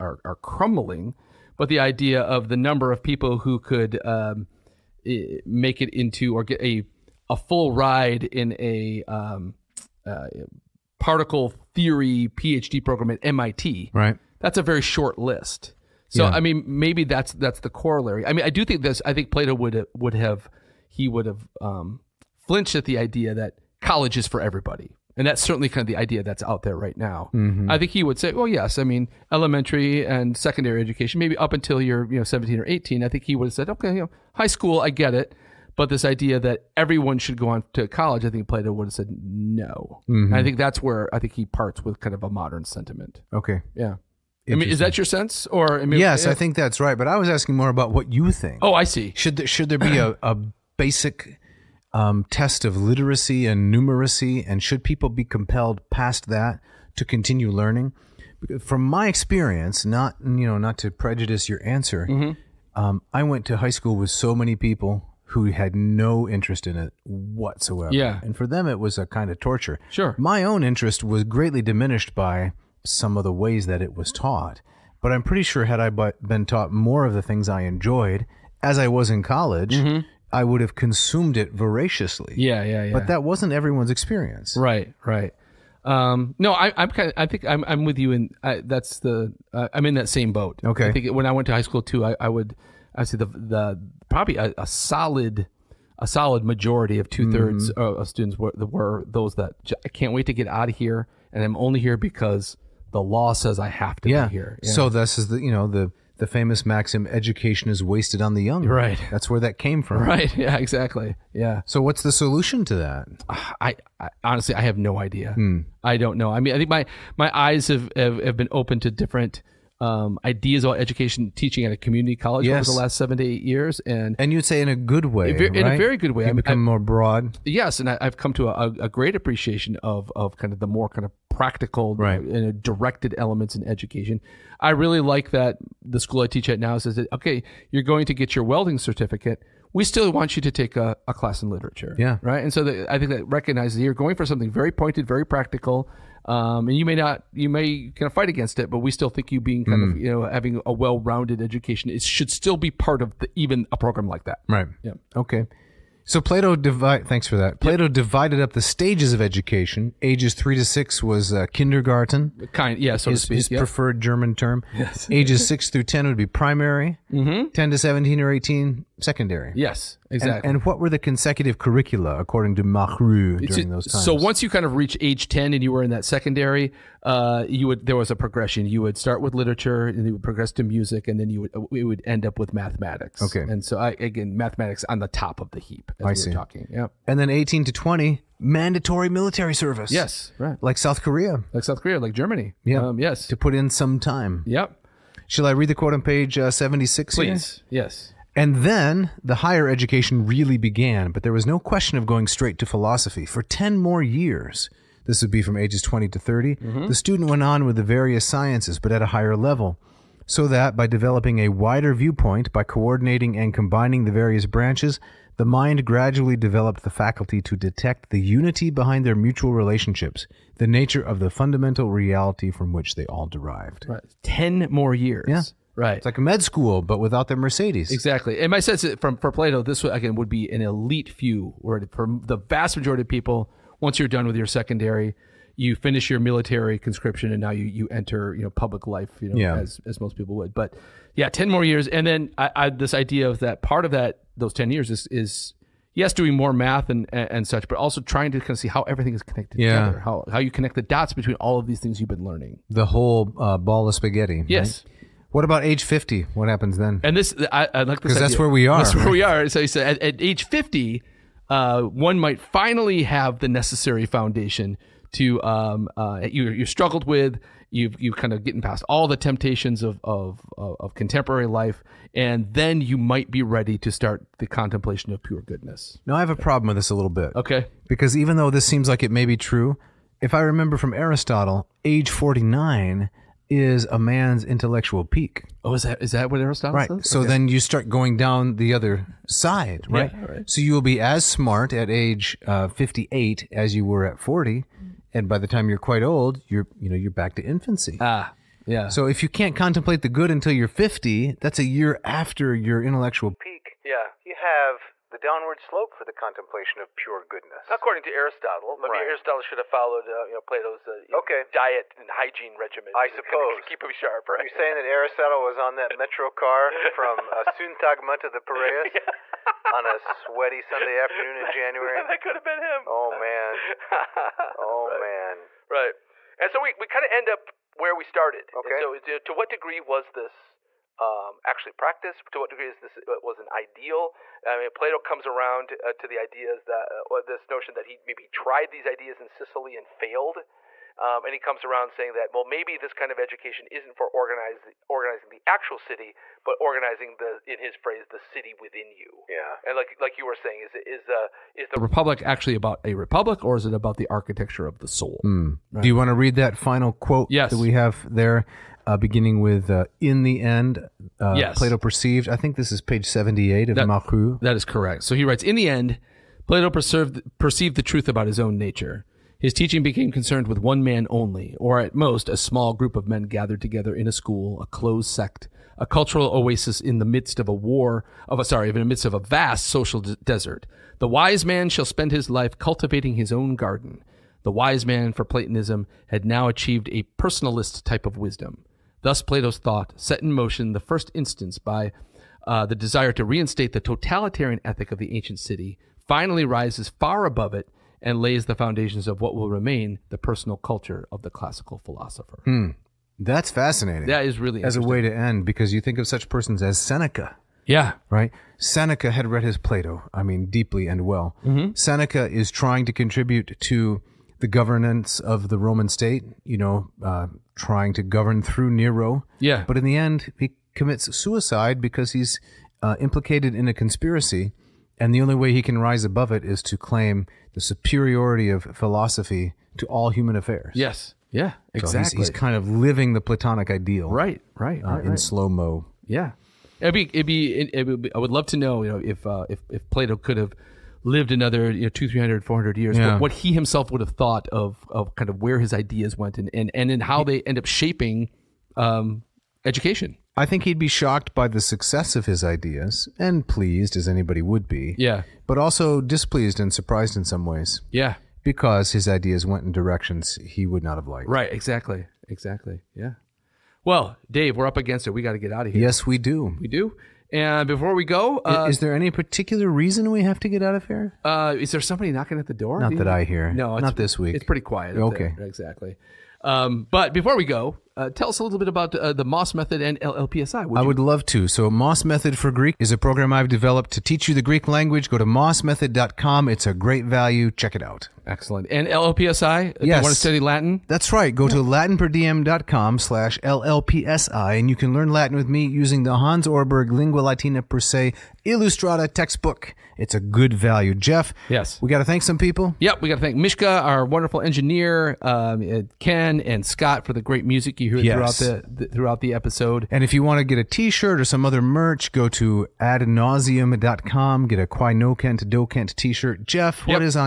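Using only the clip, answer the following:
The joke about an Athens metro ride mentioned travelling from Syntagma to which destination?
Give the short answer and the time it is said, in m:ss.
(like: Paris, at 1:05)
The Piraeus, at 5:18.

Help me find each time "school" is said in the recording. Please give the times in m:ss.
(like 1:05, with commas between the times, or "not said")
0:34, 1:03, 1:31, 2:16, 3:46, 6:14.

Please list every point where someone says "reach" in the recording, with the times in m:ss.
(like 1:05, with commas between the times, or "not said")
2:54.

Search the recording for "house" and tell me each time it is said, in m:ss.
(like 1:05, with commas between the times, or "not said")
not said.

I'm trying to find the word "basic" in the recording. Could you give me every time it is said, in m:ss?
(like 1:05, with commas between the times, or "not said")
0:50.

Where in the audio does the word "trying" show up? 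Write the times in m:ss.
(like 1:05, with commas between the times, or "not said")
4:08, 6:52, 6:57.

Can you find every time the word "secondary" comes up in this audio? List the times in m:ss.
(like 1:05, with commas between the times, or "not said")
0:30, 2:48, 2:56, 3:54.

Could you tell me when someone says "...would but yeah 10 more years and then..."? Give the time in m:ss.
4:00.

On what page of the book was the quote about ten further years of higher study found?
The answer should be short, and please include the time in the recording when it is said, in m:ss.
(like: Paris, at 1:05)
76, at 3:16.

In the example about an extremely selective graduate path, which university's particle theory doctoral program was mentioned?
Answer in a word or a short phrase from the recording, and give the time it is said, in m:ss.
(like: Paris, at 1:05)
MIT, at 0:13.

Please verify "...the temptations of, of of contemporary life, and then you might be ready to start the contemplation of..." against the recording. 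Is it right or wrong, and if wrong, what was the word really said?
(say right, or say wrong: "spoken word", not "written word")
right.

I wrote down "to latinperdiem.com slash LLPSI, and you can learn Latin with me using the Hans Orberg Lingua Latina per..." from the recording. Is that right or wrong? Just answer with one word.
right.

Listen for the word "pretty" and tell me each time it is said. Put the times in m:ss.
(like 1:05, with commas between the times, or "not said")
1:15, 7:54.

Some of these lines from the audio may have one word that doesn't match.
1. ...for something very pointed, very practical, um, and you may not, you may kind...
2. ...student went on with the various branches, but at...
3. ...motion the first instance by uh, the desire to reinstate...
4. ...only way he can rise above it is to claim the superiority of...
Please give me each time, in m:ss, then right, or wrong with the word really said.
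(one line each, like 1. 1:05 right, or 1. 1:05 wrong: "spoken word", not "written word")
1. 2:24 right
2. 3:26 wrong: "sciences", not "branches"
3. 6:30 right
4. 7:05 right.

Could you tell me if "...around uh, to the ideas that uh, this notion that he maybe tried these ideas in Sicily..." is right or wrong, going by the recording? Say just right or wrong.
right.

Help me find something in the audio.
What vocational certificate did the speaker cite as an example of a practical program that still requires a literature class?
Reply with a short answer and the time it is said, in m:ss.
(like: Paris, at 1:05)
Welding certificate, at 2:18.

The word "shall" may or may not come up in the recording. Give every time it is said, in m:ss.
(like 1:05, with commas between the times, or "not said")
3:15, 6:21.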